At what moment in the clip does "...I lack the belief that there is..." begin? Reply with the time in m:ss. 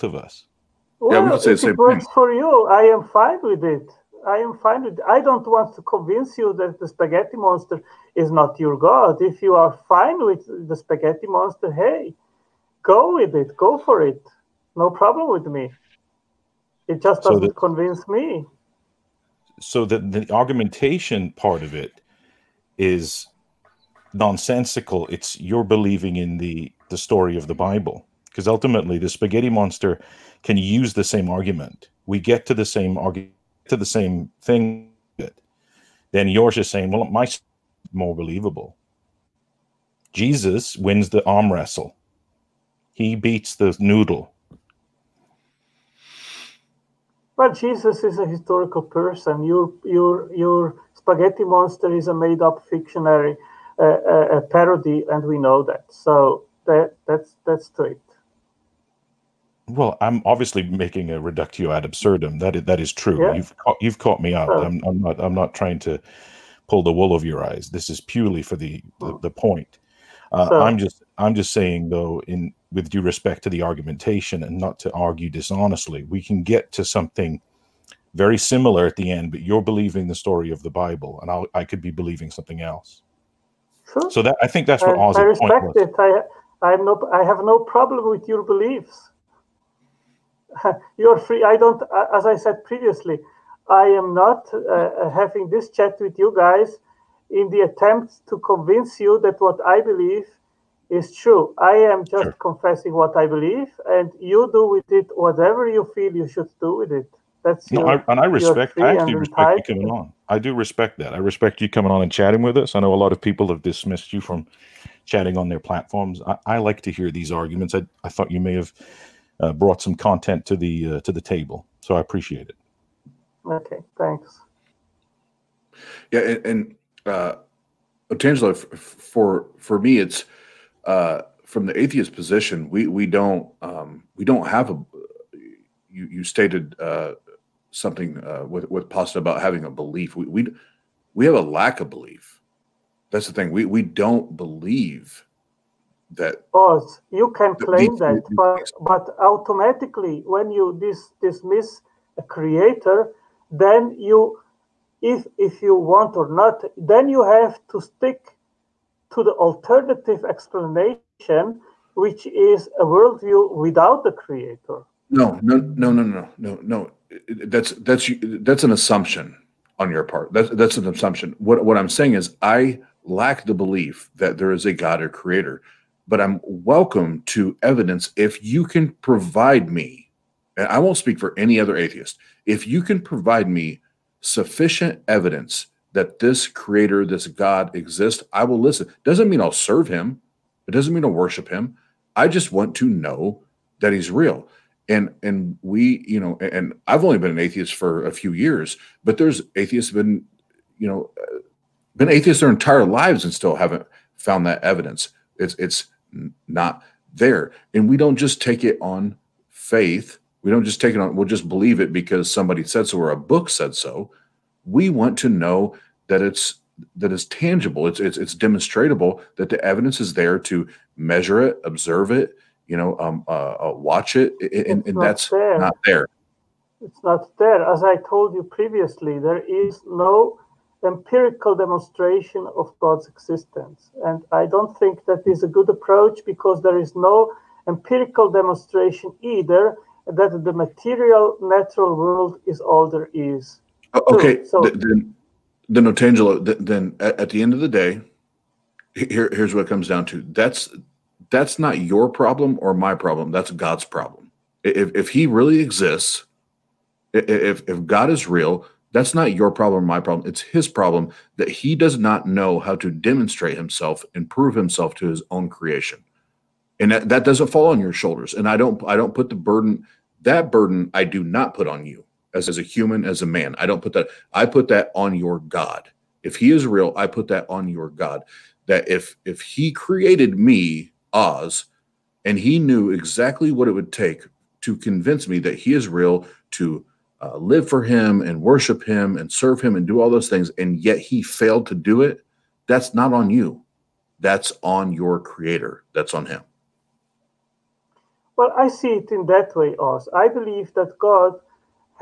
2:52.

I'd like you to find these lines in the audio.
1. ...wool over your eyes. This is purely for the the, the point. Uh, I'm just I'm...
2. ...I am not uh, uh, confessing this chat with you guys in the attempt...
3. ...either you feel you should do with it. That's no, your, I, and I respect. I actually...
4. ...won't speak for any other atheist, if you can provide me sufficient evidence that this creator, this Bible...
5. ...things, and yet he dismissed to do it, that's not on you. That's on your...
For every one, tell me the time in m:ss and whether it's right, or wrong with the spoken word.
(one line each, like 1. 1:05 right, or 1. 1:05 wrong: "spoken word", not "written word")
1. 1:06 right
2. 1:33 wrong: "having", not "confessing"
3. 1:45 wrong: "whatever", not "either"
4. 3:00 wrong: "God", not "Bible"
5. 4:50 wrong: "failed", not "dismissed".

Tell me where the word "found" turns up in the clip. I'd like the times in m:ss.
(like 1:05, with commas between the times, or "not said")
3:24.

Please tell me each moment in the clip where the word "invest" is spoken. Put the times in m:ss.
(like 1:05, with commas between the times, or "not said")
not said.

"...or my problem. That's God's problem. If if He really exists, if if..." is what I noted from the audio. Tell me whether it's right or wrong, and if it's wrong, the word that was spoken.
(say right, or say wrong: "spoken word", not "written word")
right.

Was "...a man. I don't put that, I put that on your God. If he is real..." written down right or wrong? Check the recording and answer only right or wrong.
right.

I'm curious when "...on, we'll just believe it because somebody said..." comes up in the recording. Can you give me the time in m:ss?
3:30.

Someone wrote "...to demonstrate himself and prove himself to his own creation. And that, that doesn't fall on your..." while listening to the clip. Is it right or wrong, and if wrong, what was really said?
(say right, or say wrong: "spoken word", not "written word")
right.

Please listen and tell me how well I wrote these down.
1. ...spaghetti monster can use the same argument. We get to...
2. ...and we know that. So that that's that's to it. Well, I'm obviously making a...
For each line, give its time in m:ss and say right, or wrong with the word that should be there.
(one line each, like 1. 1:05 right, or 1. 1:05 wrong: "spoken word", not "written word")
1. 0:29 right
2. 0:55 right.